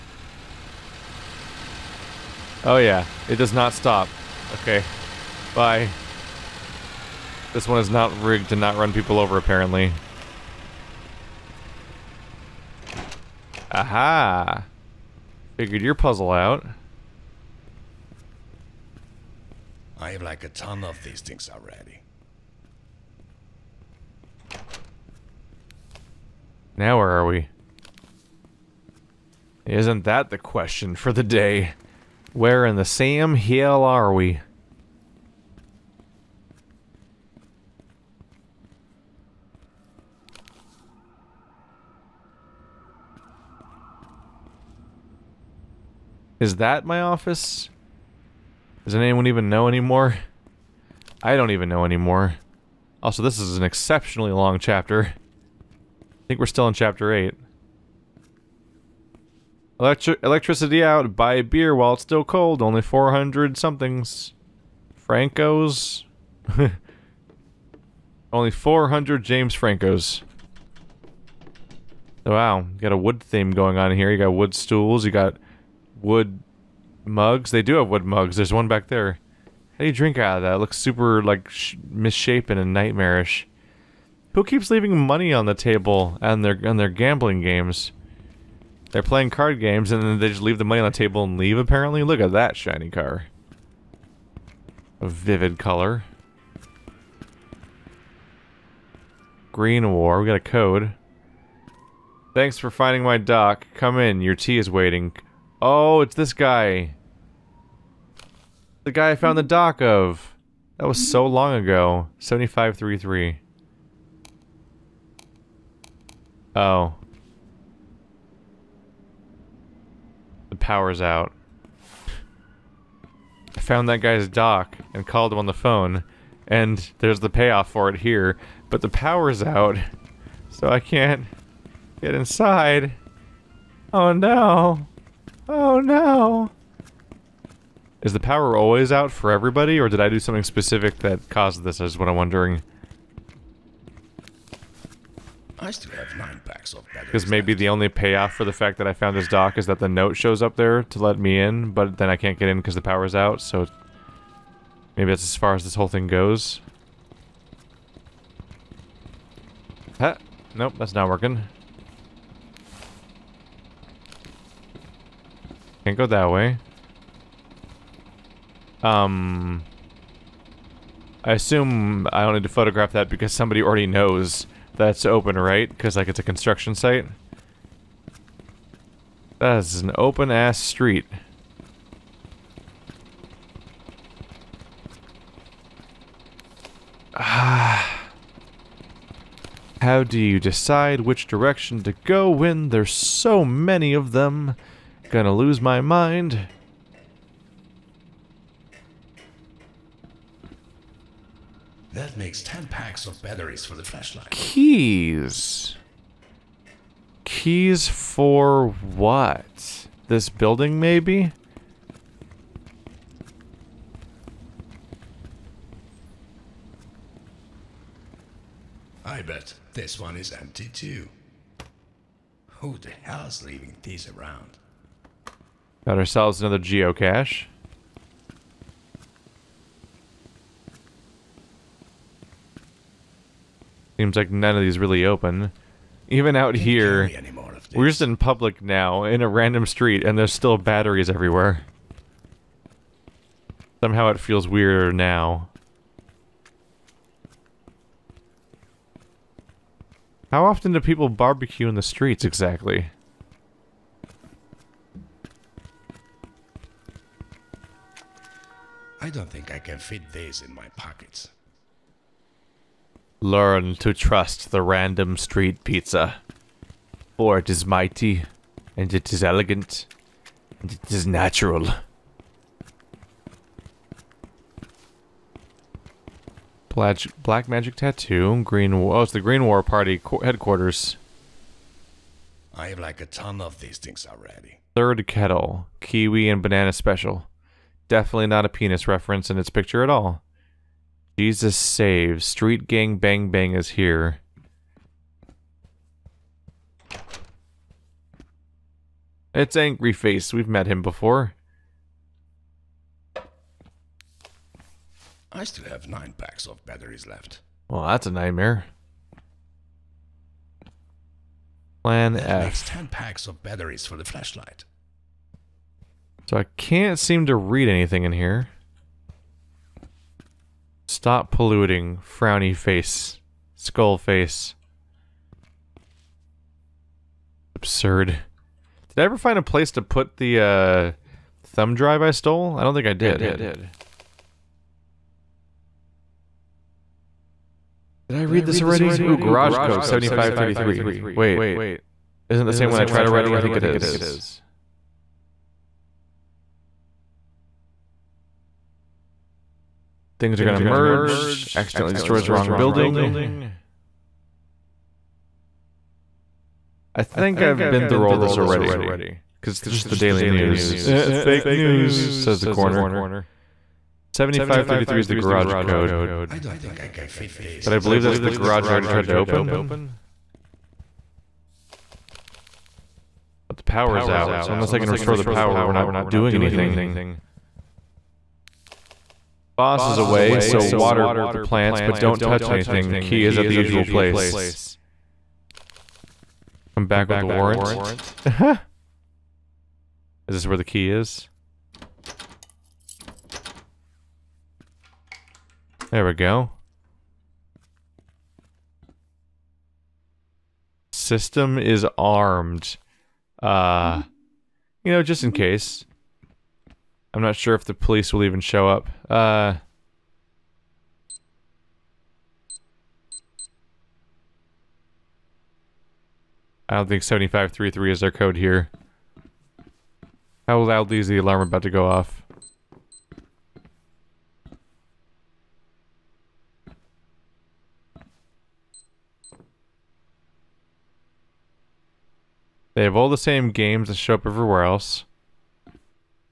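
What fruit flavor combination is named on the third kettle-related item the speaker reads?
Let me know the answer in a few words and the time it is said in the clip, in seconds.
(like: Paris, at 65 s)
Kiwi and banana, at 285 s.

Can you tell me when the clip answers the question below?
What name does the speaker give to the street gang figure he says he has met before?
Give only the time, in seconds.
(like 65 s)
299 s.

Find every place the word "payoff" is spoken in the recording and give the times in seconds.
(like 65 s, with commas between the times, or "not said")
127 s, 147 s.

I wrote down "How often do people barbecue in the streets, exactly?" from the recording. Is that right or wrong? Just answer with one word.
right.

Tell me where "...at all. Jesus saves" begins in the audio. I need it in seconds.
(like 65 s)
289 s.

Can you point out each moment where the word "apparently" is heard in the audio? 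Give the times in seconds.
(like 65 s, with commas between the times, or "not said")
9 s, 91 s.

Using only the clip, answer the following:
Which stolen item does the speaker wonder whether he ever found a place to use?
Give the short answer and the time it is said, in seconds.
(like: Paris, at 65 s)
Thumb drive, at 331 s.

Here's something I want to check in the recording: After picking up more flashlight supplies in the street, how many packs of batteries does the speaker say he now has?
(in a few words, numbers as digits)
10.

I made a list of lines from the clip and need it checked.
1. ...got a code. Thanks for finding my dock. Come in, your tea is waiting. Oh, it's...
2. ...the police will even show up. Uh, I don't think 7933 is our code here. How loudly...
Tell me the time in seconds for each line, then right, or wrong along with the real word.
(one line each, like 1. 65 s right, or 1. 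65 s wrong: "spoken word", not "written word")
1. 100 s right
2. 407 s wrong: "7533", not "7933".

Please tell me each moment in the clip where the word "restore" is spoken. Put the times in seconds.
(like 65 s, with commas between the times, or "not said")
374 s.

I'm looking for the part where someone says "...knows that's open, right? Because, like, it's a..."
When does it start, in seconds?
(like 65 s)
173 s.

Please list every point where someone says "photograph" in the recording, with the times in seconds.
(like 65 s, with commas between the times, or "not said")
172 s.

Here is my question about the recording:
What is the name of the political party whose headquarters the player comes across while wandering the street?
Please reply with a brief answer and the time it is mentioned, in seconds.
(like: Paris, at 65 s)
Green War Party, at 279 s.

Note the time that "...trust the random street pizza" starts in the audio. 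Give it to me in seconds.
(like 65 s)
263 s.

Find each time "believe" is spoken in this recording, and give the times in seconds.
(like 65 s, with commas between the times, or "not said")
367 s.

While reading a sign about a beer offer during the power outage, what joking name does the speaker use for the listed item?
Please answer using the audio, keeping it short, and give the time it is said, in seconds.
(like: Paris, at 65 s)
James Franco's, at 69 s.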